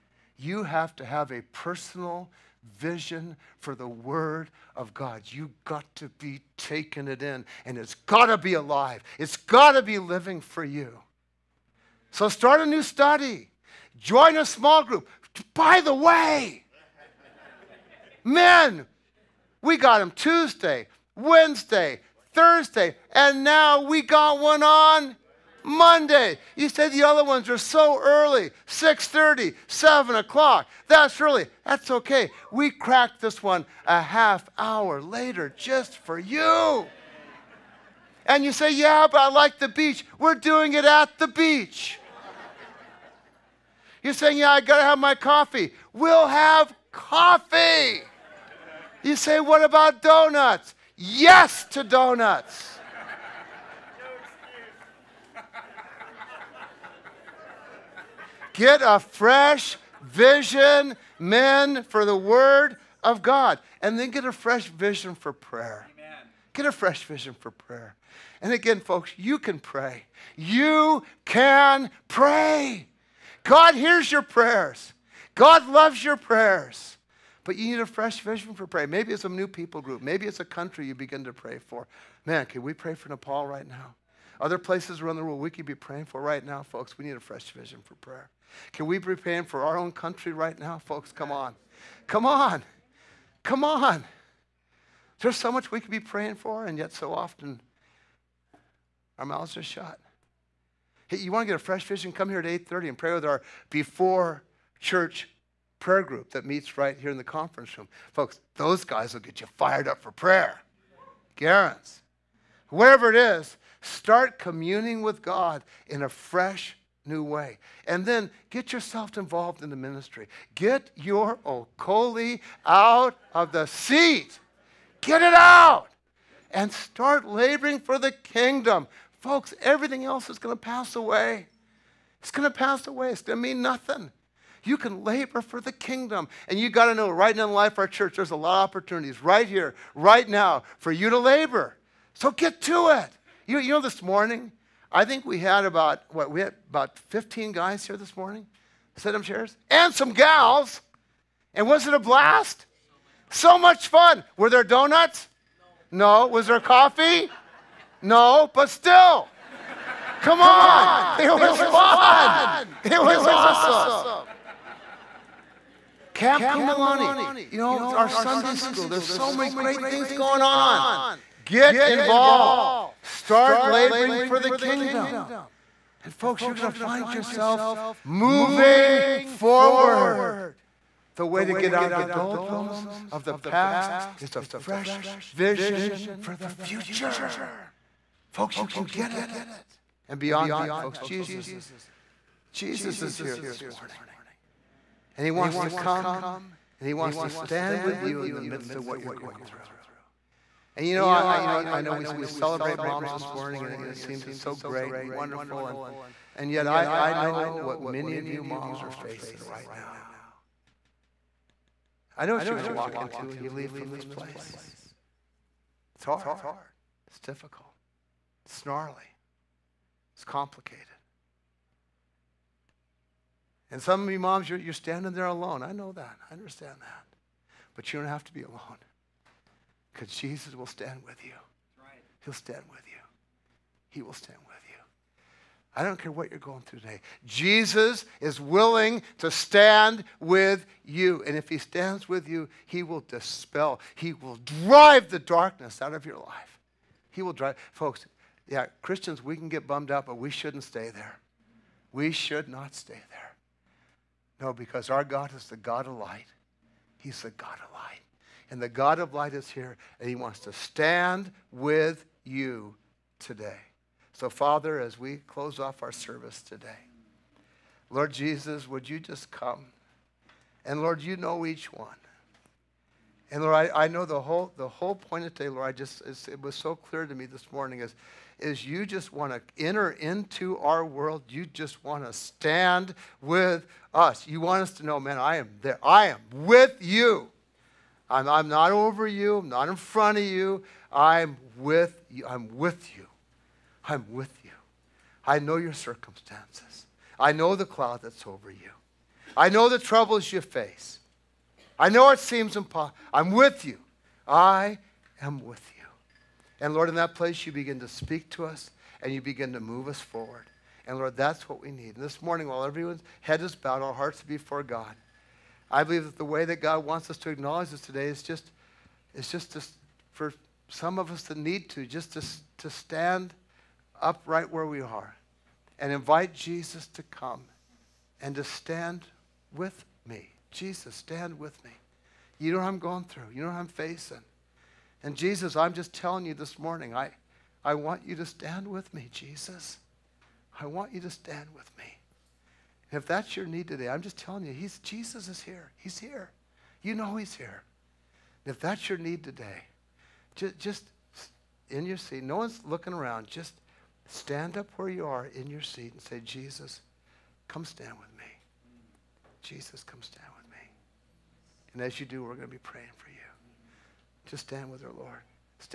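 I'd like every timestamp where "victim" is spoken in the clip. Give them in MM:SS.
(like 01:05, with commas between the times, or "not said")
not said.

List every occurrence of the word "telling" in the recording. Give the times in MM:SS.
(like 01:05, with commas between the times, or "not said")
05:35, 05:44.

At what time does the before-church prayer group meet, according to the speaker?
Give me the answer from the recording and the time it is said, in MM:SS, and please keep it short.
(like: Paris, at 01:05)
8:30, at 01:42.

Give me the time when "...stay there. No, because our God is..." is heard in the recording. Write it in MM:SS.
04:12.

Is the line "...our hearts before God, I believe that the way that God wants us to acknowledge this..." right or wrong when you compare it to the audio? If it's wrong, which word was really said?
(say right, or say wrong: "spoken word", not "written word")
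right.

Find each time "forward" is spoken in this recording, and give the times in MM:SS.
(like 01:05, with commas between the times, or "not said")
02:59, 05:10.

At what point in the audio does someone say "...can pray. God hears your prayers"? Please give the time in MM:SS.
01:11.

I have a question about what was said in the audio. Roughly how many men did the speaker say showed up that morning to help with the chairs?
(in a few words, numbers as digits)
15.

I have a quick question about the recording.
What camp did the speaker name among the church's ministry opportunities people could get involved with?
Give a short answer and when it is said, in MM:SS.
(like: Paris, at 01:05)
Camp Kumulani, at 02:46.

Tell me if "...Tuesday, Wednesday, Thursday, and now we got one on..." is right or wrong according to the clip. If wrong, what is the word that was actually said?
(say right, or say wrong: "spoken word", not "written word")
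right.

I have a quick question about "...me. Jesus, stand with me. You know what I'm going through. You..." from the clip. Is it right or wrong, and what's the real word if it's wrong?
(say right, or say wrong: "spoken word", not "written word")
right.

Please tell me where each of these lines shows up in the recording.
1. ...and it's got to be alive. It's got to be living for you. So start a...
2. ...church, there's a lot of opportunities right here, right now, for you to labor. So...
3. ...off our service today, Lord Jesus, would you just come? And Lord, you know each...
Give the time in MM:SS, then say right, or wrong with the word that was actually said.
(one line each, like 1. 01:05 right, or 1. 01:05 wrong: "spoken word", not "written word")
1. 00:07 right
2. 02:17 right
3. 04:25 right.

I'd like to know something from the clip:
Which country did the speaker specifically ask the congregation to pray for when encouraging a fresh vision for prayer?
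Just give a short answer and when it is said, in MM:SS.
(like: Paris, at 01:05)
Nepal, at 01:23.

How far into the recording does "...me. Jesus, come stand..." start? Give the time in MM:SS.
05:58.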